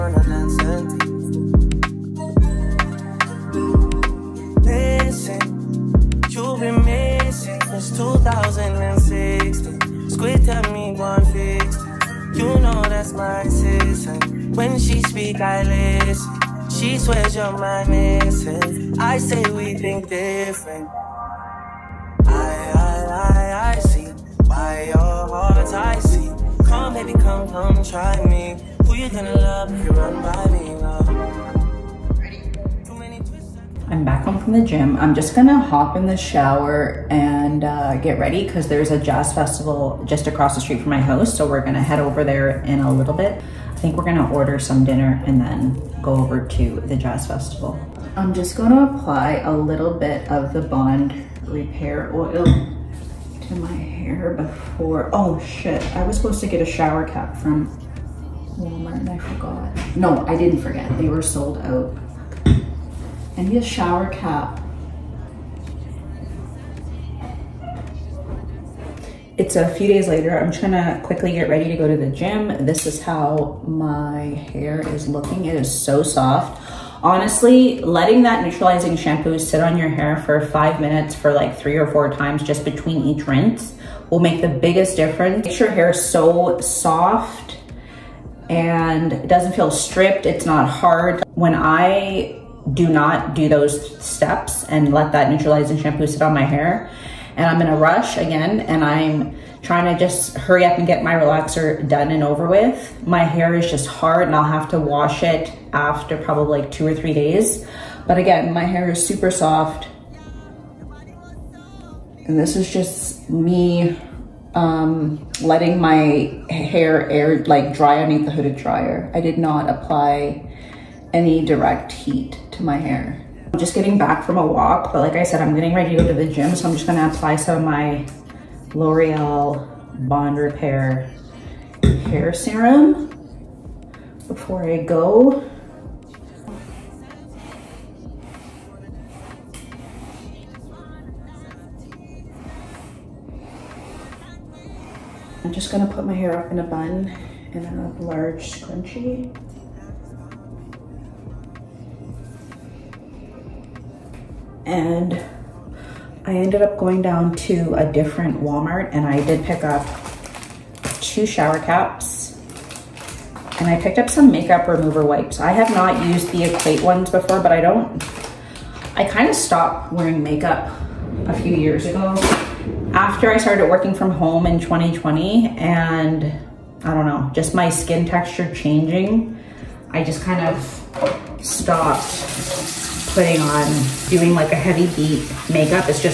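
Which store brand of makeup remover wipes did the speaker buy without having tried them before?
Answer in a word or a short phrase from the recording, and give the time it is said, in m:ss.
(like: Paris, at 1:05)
Equate, at 2:46.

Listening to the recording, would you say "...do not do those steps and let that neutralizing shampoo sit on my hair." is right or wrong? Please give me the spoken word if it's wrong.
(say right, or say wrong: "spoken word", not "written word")
right.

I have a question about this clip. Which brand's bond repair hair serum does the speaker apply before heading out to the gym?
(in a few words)
L'Oreal.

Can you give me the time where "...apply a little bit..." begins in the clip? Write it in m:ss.
0:48.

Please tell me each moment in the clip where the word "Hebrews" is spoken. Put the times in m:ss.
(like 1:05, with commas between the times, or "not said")
not said.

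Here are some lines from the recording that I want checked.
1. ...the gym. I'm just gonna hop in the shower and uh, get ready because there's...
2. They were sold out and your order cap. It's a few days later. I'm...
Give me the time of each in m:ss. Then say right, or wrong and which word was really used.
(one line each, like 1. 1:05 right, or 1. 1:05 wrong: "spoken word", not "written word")
1. 0:34 right
2. 1:00 wrong: "shower", not "order".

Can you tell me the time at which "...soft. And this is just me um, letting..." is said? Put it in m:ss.
1:49.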